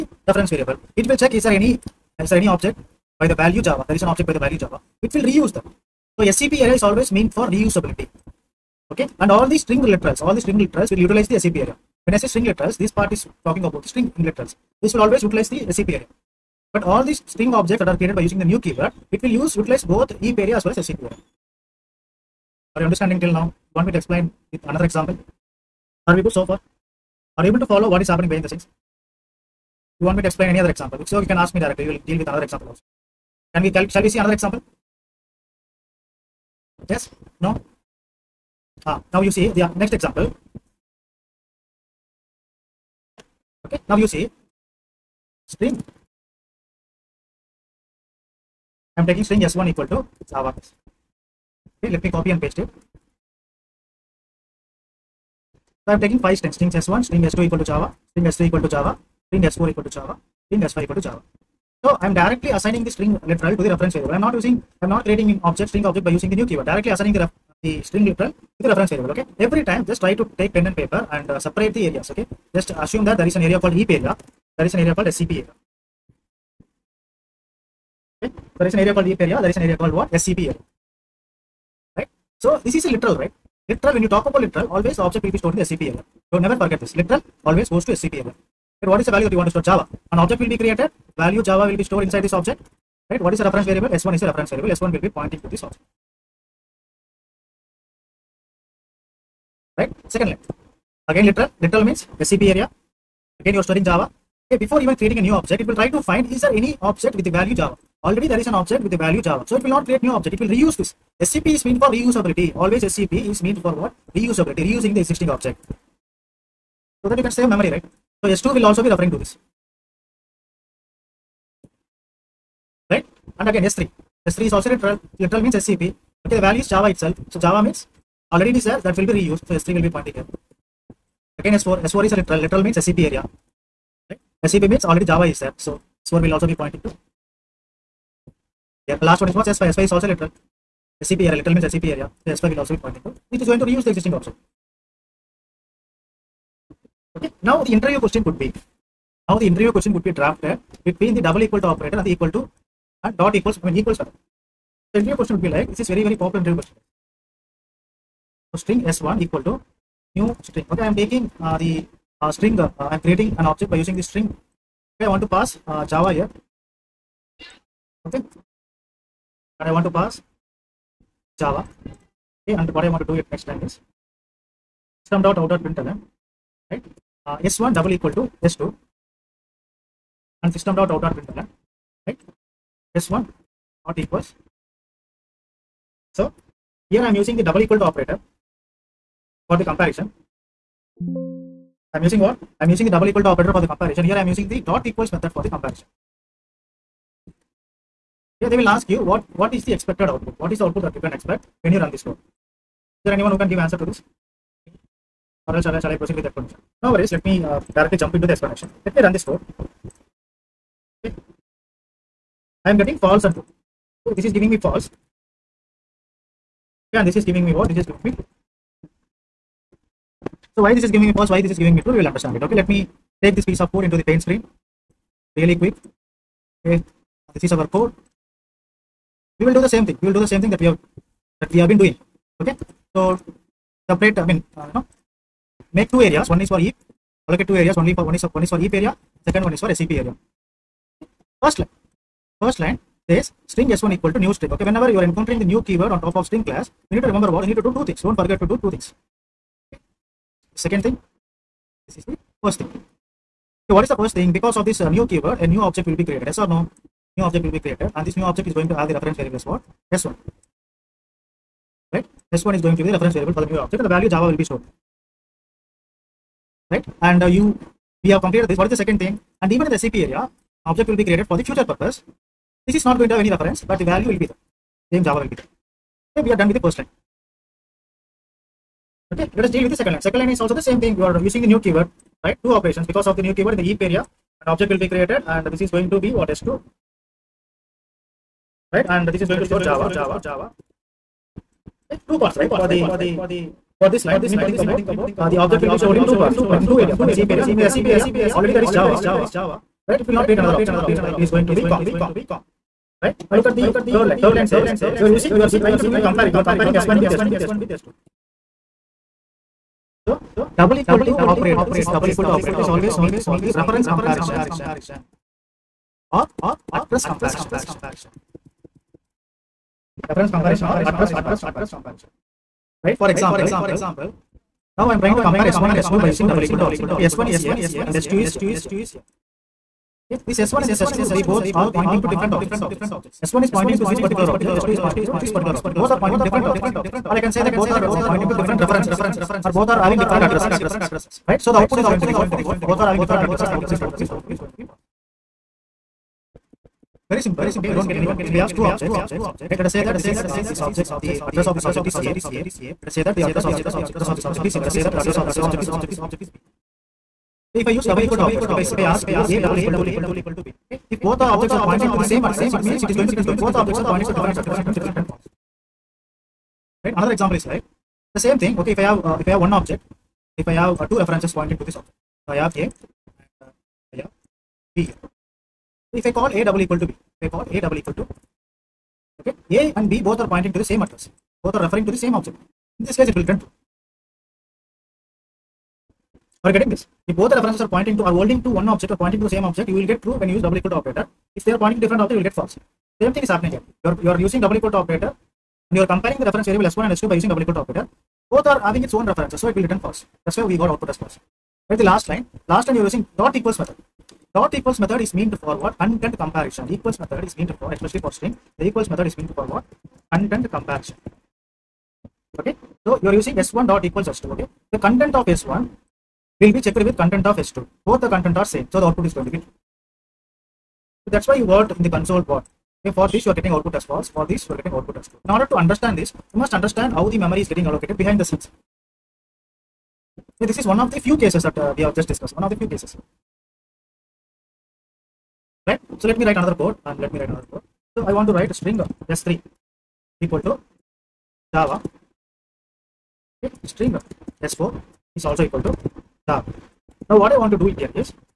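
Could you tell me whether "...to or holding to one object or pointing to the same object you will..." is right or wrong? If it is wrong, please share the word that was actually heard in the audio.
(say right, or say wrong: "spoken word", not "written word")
right.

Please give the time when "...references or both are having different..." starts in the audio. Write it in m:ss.
5:38.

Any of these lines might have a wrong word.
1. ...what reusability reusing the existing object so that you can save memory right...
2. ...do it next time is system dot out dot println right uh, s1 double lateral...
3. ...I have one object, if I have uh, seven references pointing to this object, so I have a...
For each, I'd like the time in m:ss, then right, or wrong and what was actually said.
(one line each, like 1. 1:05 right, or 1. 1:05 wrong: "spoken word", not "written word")
1. 1:53 right
2. 2:53 wrong: "equal", not "lateral"
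3. 6:09 wrong: "two", not "seven".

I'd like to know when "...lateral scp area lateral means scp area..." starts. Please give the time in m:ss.
2:20.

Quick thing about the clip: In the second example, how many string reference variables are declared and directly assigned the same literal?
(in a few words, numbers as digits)
5.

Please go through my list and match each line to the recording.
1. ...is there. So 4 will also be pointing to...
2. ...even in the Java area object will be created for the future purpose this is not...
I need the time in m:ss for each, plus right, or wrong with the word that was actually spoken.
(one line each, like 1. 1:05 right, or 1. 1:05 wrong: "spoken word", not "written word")
1. 2:15 right
2. 4:29 wrong: "SCP", not "Java".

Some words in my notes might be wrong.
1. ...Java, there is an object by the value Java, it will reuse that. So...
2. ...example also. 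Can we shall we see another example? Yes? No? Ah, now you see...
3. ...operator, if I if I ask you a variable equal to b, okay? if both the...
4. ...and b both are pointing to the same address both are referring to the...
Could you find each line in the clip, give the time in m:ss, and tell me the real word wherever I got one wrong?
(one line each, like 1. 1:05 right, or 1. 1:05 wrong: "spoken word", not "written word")
1. 0:03 right
2. 0:32 right
3. 5:58 wrong: "double", not "variable"
4. 6:19 right.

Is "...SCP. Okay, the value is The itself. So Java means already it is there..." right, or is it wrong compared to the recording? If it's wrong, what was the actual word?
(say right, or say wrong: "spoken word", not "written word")
wrong: "Java", not "The".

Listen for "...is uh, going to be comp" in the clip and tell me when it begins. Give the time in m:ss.
5:01.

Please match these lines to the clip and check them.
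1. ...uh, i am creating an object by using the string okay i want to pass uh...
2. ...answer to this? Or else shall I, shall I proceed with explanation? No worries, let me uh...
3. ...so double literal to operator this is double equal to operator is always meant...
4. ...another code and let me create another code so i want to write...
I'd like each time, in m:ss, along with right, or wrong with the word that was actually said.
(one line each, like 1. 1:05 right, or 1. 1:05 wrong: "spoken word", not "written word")
1. 2:42 right
2. 3:23 right
3. 5:10 wrong: "equal", not "literal"
4. 7:16 wrong: "write", not "create".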